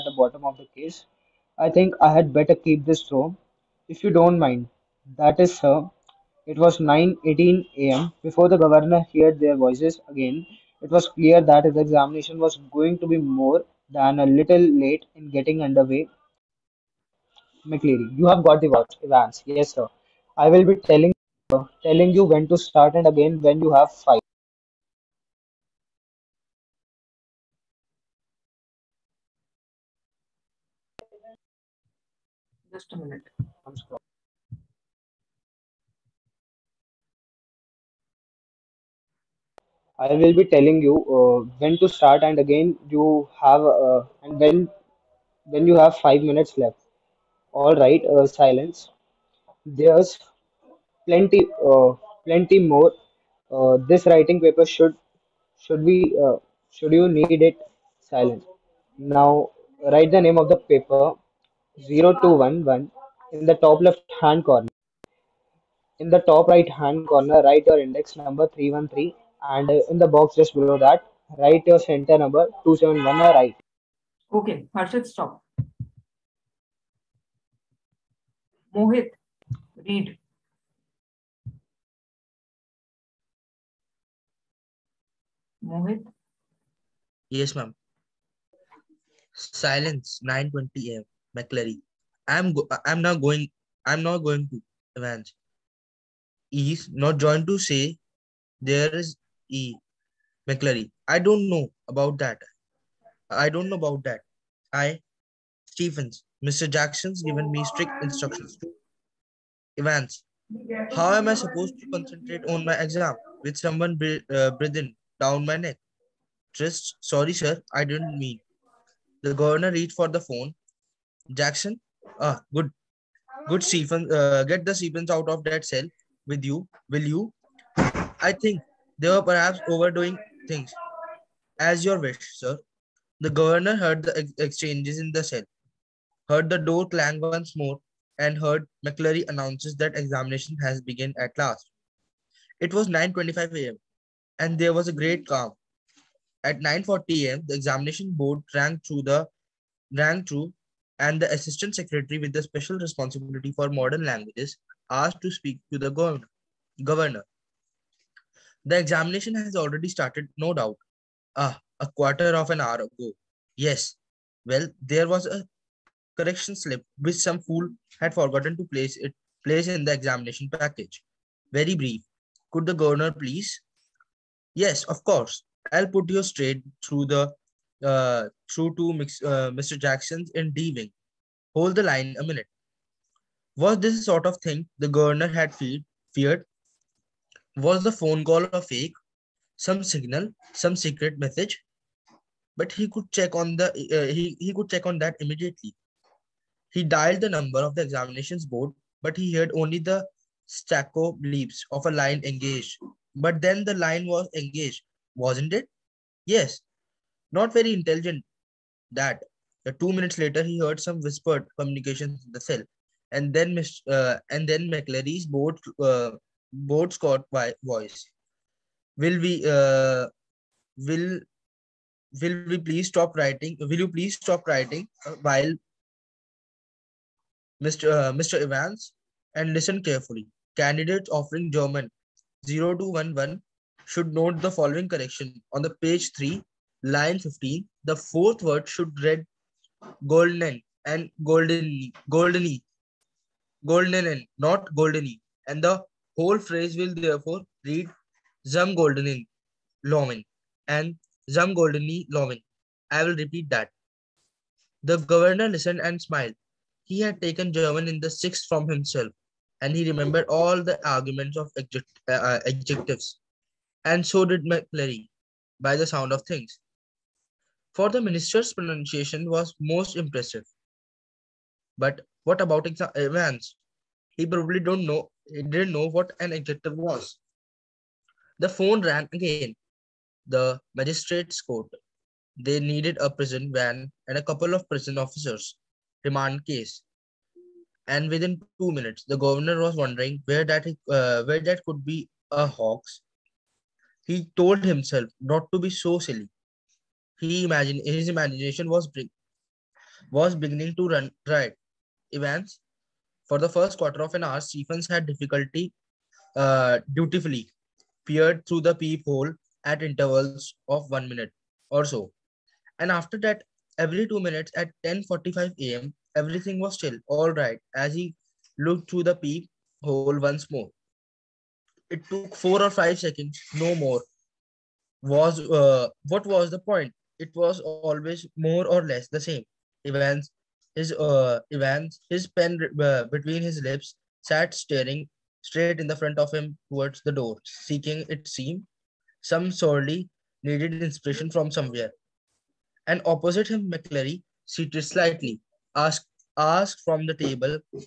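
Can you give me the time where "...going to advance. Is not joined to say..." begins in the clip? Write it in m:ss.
1:34.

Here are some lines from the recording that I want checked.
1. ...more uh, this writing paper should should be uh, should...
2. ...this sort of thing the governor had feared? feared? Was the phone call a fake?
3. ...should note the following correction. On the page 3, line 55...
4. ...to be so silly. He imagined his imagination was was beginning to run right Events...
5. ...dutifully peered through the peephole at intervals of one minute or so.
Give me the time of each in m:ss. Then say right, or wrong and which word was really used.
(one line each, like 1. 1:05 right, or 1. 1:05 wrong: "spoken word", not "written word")
1. 0:52 right
2. 3:03 right
3. 3:53 wrong: "15", not "55"
4. 4:55 right
5. 5:06 right.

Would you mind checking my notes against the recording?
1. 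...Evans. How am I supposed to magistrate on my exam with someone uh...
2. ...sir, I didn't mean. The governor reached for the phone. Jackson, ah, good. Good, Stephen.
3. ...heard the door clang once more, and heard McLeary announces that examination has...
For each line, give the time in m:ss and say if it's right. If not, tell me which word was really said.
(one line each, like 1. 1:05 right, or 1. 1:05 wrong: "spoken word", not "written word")
1. 1:49 wrong: "concentrate", not "magistrate"
2. 1:57 right
3. 2:16 right.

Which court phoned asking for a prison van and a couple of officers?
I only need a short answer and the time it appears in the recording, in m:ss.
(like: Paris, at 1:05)
The magistrate's court, at 4:40.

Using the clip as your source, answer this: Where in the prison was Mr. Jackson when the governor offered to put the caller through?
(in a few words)
D wing.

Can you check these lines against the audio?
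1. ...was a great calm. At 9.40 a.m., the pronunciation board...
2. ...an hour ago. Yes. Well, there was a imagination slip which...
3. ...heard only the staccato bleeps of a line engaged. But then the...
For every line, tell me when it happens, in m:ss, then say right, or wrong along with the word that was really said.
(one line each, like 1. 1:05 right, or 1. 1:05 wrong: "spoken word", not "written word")
1. 2:24 wrong: "examination", not "pronunciation"
2. 2:42 wrong: "correction", not "imagination"
3. 3:19 right.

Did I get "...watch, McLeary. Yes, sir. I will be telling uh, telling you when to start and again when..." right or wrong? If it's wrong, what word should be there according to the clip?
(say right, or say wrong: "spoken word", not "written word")
wrong: "Evans", not "McLeary".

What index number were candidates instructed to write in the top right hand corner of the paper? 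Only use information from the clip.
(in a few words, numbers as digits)
313.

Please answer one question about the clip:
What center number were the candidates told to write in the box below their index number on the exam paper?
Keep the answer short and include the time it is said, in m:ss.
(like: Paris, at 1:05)
271, at 1:12.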